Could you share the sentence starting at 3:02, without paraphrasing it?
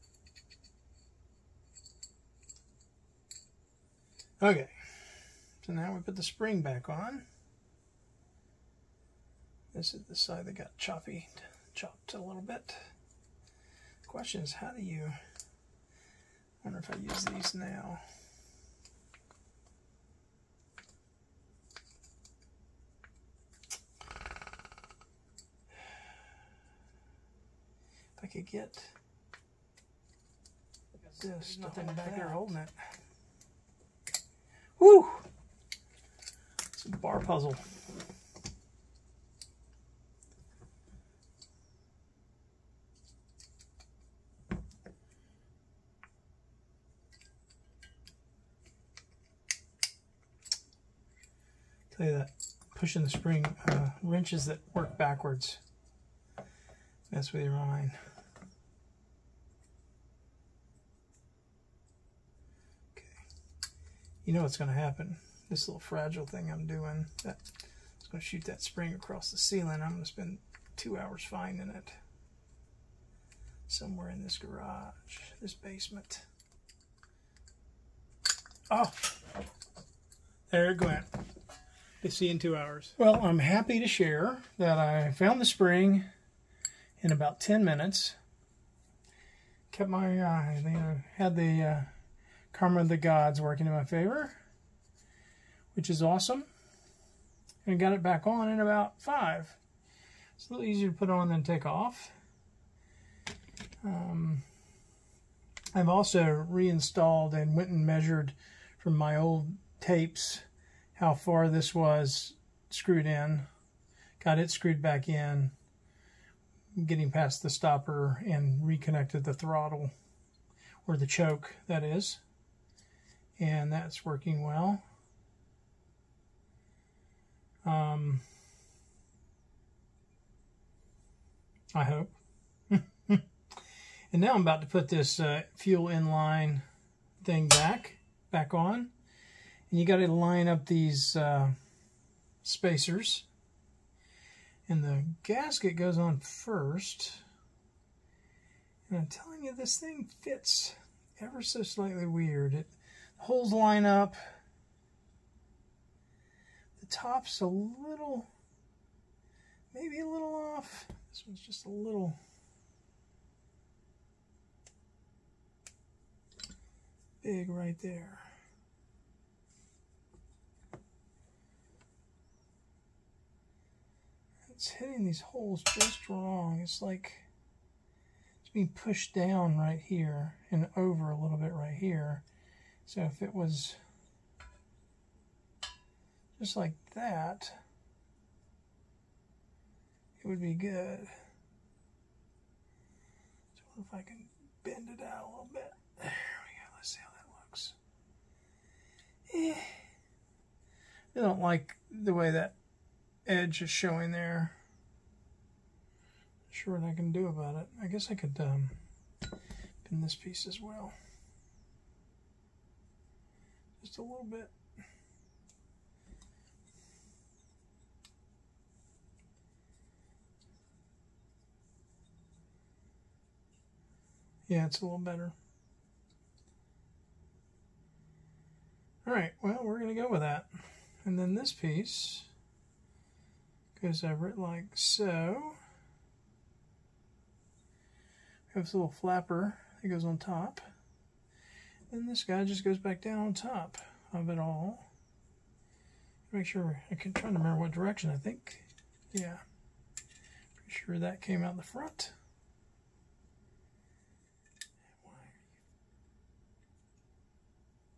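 So if it was just like that, it would be good.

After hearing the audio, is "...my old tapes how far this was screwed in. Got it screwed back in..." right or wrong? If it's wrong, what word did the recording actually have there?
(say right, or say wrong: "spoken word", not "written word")
right.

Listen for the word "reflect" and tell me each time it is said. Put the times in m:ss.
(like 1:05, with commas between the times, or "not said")
not said.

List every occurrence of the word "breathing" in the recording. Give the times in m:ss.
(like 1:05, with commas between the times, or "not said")
not said.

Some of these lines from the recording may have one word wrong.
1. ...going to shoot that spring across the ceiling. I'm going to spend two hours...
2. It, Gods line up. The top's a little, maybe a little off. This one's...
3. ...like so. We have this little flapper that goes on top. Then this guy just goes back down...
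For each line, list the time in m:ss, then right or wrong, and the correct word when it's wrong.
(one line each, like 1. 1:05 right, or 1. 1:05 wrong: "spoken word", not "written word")
1. 1:08 right
2. 2:32 wrong: "Holes", not "Gods"
3. 3:54 right.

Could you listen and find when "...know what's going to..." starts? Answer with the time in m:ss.
1:04.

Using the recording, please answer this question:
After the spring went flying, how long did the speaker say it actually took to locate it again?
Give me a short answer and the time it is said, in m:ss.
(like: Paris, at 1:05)
10 minutes, at 1:27.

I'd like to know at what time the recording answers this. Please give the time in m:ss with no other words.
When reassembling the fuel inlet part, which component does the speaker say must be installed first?
2:25.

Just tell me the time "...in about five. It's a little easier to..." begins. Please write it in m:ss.
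1:38.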